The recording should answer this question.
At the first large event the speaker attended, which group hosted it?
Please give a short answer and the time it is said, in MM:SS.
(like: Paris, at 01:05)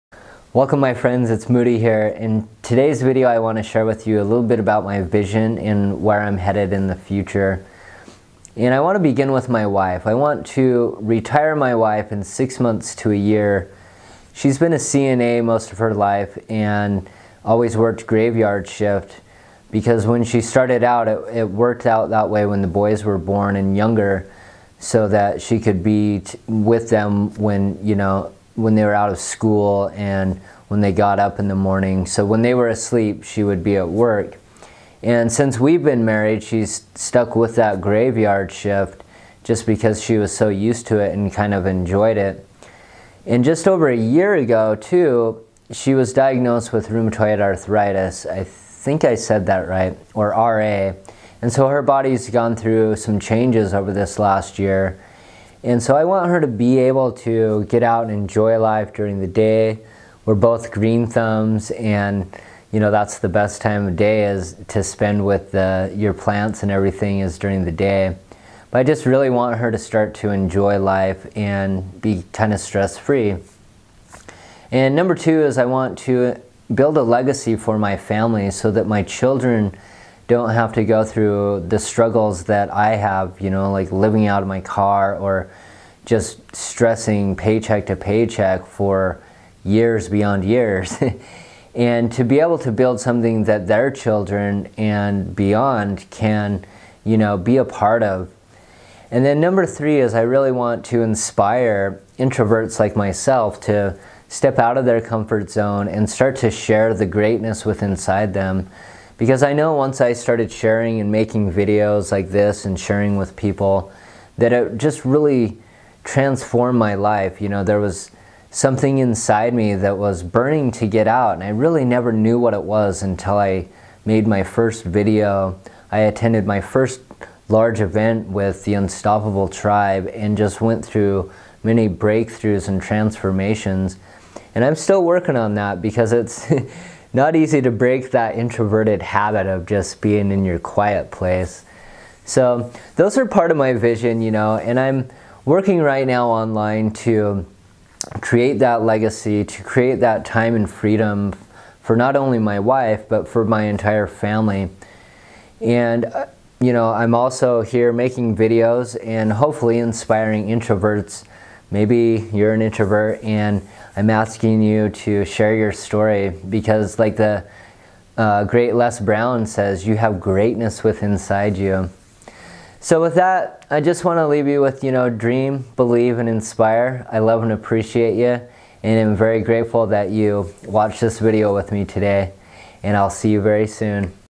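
Unstoppable Tribe, at 02:08.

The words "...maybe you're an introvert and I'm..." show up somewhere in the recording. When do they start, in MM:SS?
02:41.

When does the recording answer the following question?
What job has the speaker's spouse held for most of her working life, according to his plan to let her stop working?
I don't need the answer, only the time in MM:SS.
00:14.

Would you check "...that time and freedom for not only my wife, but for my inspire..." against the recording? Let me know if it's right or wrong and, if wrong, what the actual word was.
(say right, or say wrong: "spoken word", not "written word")
wrong: "entire", not "inspire".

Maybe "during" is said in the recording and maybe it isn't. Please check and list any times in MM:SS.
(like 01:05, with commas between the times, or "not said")
00:58, 01:07.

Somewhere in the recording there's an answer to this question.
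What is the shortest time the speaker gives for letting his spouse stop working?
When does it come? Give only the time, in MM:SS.
00:12.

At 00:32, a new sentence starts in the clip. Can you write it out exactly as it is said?
So when they were asleep, she would be at work.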